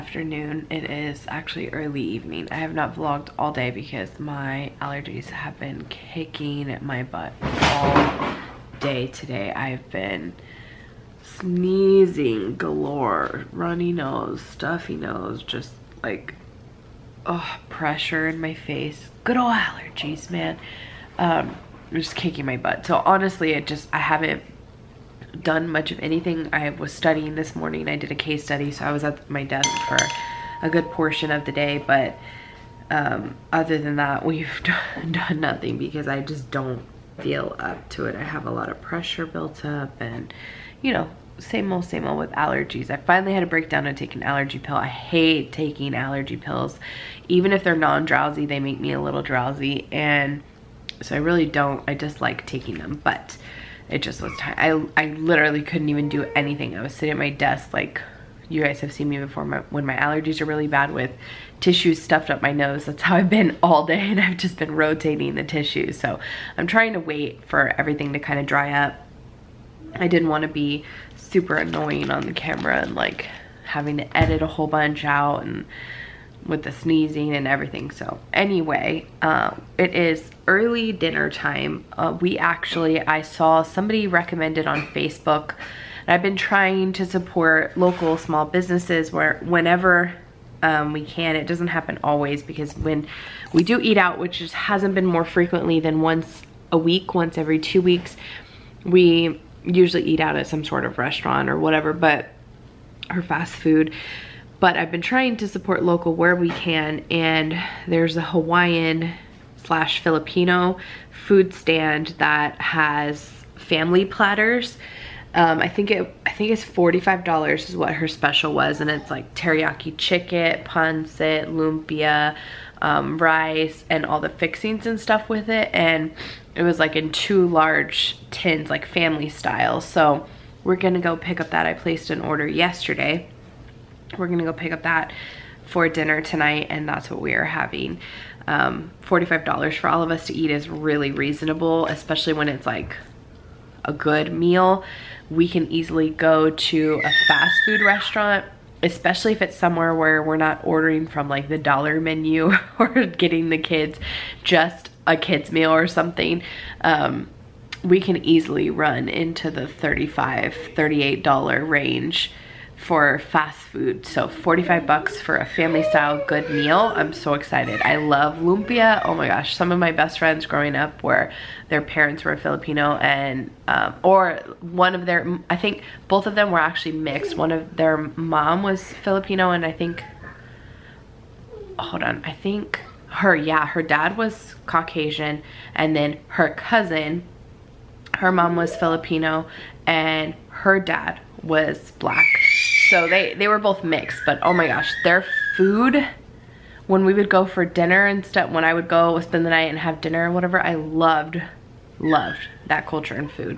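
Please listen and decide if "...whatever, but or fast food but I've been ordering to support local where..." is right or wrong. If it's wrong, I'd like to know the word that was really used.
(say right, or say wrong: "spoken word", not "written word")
wrong: "trying", not "ordering".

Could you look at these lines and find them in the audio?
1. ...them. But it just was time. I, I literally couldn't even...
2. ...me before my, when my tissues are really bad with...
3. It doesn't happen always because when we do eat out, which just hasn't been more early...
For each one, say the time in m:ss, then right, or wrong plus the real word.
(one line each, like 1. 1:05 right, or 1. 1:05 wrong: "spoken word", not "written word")
1. 0:52 right
2. 0:59 wrong: "allergies", not "tissues"
3. 1:31 wrong: "frequently", not "early".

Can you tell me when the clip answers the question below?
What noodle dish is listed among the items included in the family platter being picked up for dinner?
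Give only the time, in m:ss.
2:00.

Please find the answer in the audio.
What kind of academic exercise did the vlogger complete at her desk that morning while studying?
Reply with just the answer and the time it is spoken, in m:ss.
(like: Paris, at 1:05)
case study, at 0:28.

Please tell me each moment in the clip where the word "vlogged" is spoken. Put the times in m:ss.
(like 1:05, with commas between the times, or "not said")
0:02.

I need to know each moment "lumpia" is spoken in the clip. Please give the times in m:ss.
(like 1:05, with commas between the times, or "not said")
2:01, 2:48.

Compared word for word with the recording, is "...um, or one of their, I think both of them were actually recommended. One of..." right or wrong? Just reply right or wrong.
wrong.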